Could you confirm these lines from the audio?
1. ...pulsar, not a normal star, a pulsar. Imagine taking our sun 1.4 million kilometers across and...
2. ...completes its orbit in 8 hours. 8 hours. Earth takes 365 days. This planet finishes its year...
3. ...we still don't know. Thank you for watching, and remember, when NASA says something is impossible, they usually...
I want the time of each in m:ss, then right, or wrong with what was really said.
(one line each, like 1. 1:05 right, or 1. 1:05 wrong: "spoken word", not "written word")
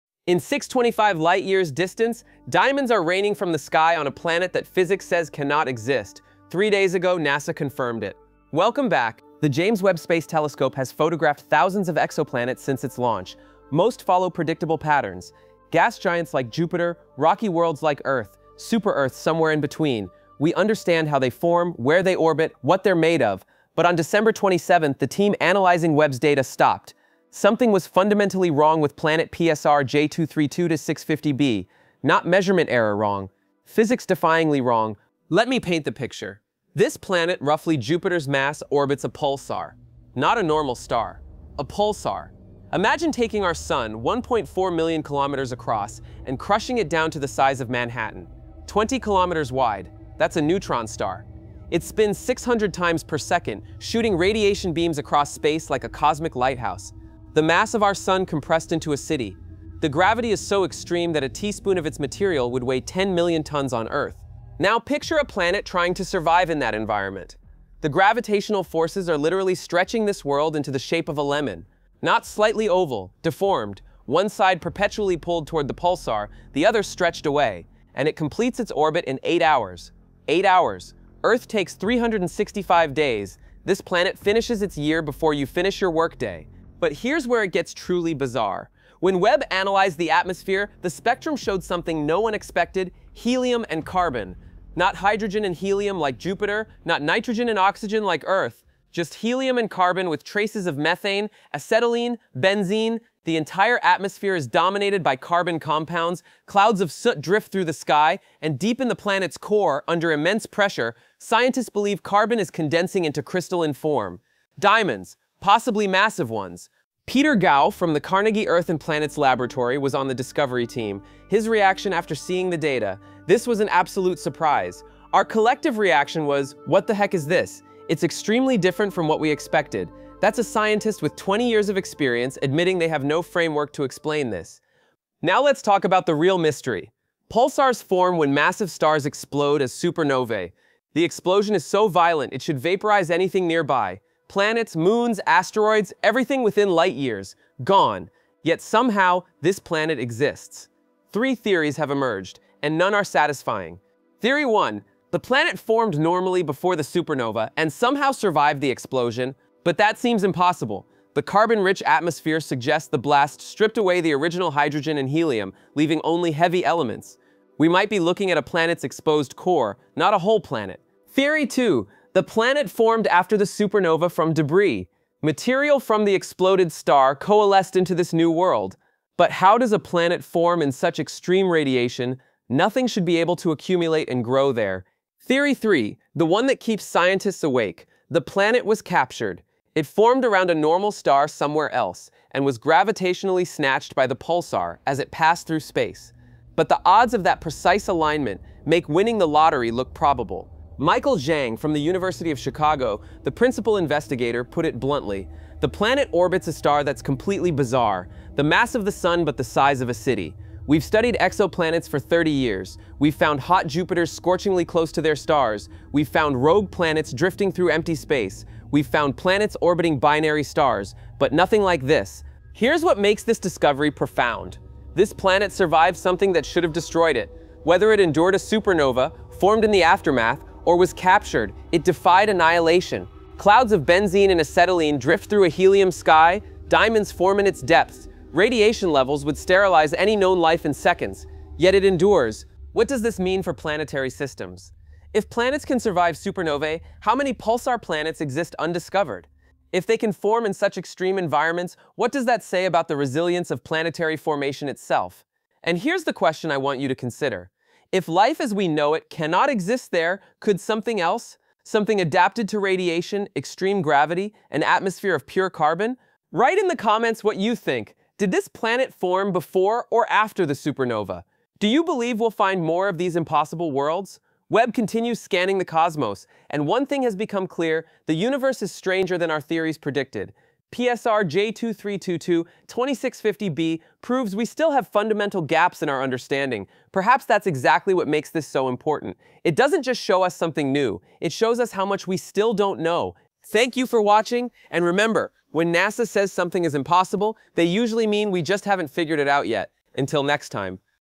1. 0:39 right
2. 1:18 right
3. 4:52 right.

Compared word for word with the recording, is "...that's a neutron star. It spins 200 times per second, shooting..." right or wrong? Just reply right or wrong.
wrong.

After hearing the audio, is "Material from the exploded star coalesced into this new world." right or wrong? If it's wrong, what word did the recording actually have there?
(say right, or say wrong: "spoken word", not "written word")
right.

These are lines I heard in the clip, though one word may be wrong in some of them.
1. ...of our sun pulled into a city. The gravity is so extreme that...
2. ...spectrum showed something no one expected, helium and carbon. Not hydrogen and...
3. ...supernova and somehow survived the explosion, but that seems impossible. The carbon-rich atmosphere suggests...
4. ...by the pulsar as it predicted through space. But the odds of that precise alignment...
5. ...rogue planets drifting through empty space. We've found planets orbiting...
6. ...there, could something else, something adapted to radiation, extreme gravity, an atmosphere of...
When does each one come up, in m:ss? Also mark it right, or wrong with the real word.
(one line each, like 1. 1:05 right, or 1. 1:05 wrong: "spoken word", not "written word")
1. 0:57 wrong: "compressed", not "pulled"
2. 1:30 right
3. 2:36 right
4. 3:13 wrong: "passed", not "predicted"
5. 3:36 right
6. 4:19 right.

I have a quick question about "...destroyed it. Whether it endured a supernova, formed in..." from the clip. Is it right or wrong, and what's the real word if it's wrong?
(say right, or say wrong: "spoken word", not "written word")
right.